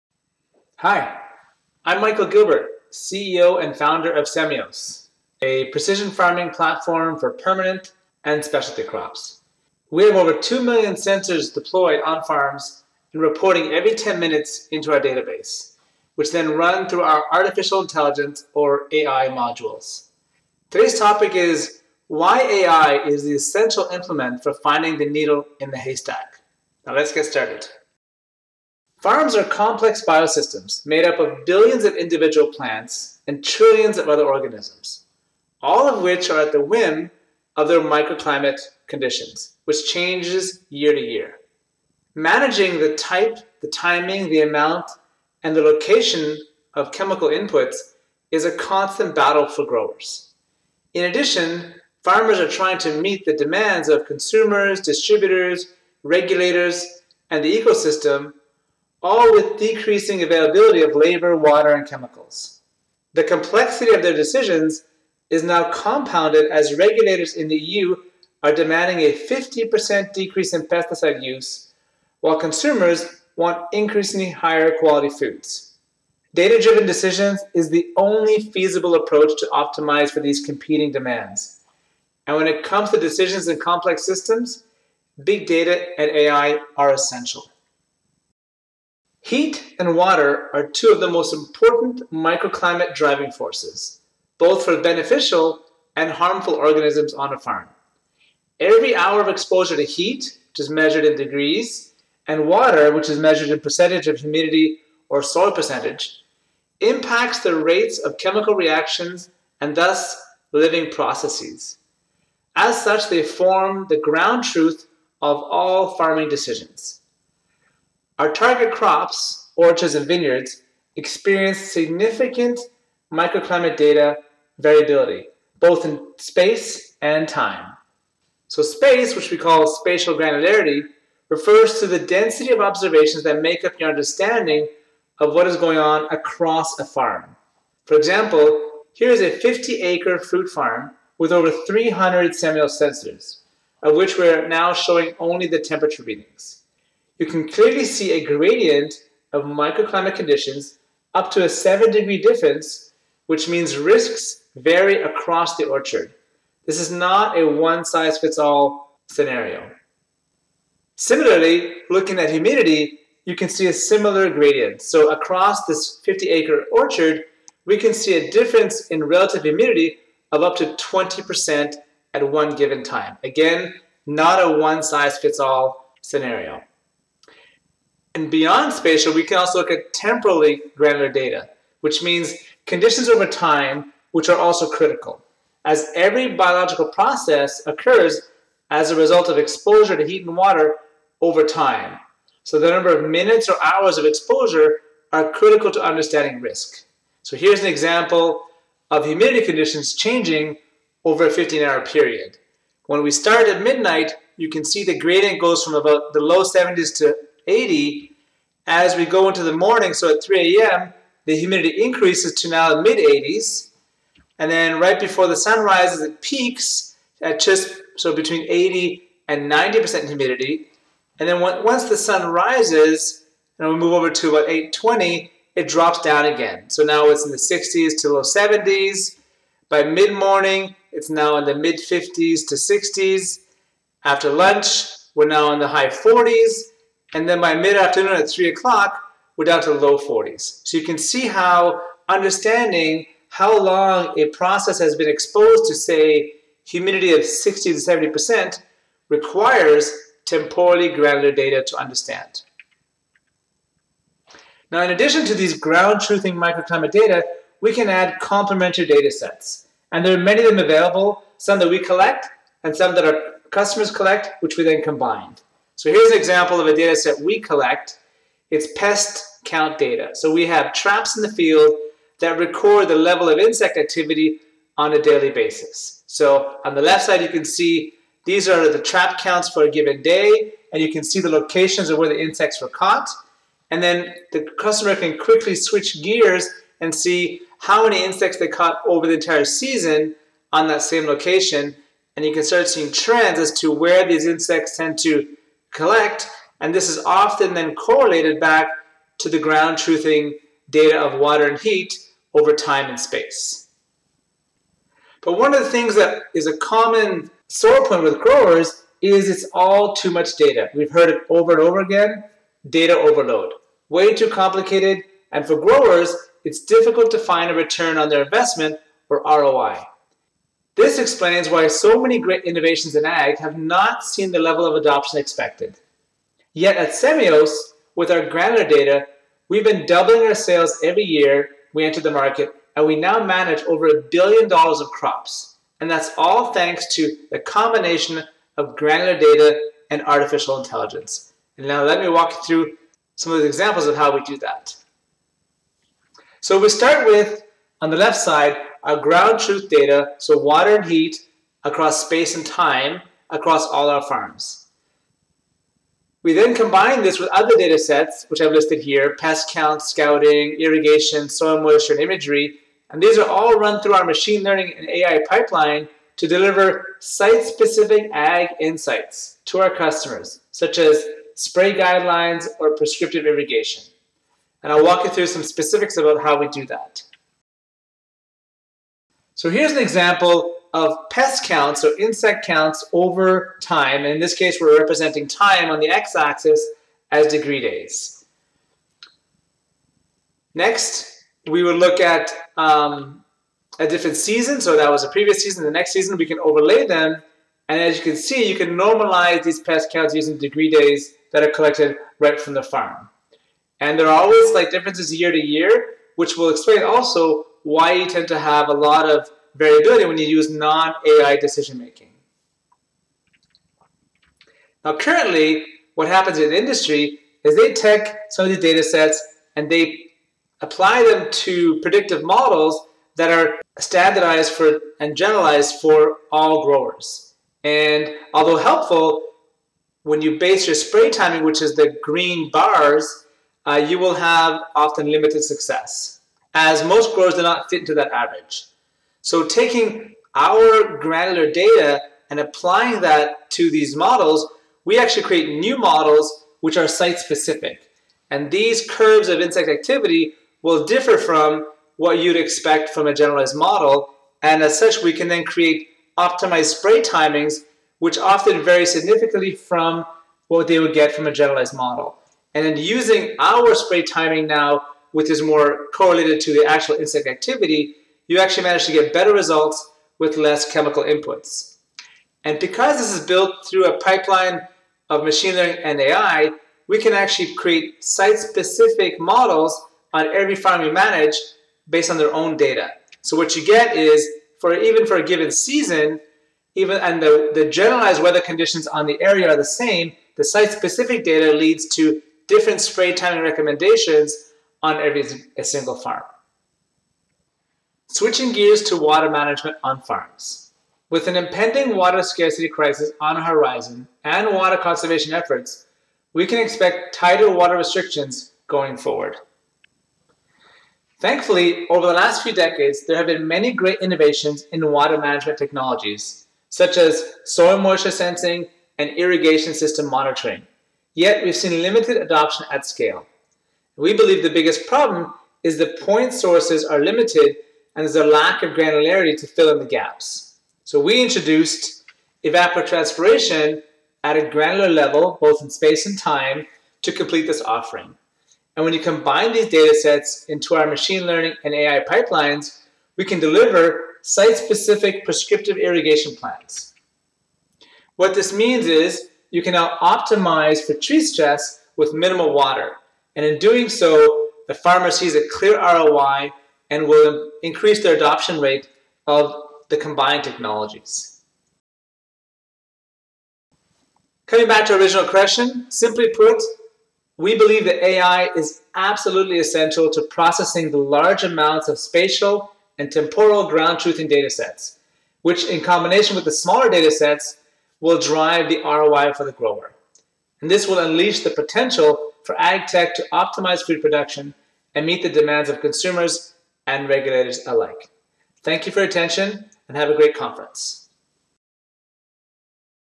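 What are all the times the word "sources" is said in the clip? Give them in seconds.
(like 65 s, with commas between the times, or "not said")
526 s.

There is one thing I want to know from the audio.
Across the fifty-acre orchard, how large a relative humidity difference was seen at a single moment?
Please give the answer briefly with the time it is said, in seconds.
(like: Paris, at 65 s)
20%, at 170 s.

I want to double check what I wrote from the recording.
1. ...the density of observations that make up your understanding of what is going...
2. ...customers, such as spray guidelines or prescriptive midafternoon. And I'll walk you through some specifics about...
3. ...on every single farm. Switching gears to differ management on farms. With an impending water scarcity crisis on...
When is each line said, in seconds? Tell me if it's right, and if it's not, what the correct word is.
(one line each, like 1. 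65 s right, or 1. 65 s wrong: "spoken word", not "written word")
1. 131 s right
2. 369 s wrong: "irrigation", not "midafternoon"
3. 494 s wrong: "water", not "differ".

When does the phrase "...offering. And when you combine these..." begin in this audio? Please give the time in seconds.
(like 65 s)
537 s.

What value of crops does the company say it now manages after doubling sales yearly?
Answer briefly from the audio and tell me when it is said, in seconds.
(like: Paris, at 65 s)
over a billion dollars, at 333 s.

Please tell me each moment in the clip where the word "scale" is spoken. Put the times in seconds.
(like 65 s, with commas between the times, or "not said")
522 s.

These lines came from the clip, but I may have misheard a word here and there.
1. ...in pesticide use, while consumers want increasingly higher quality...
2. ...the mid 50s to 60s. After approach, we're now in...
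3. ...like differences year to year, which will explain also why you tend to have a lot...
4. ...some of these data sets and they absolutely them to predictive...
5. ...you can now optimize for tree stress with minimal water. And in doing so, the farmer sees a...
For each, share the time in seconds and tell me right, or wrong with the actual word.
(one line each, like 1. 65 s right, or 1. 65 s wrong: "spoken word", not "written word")
1. 70 s right
2. 231 s wrong: "lunch", not "approach"
3. 404 s right
4. 418 s wrong: "apply", not "absolutely"
5. 549 s right.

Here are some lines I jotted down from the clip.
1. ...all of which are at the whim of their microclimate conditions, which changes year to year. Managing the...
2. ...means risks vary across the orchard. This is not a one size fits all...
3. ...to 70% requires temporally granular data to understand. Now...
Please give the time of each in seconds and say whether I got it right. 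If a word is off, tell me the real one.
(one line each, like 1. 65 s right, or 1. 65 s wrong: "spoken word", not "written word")
1. 35 s right
2. 153 s right
3. 247 s right.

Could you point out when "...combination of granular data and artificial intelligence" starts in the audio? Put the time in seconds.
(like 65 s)
337 s.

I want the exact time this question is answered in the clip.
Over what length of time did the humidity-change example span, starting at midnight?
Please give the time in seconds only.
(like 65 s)
201 s.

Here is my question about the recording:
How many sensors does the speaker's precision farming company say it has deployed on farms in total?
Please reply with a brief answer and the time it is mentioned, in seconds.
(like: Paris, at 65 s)
over 2 million, at 10 s.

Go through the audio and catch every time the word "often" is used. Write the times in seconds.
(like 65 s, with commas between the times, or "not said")
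297 s, 434 s, 458 s.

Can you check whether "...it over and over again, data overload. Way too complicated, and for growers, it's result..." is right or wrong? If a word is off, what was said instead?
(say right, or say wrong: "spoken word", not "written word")
wrong: "difficult", not "result".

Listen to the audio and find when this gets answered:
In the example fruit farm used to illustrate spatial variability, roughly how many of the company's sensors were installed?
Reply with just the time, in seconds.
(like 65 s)
141 s.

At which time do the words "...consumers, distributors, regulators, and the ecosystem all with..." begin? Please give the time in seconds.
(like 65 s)
54 s.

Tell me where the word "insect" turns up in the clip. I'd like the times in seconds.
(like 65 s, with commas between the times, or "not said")
273 s, 282 s, 288 s, 294 s, 381 s, 449 s, 466 s.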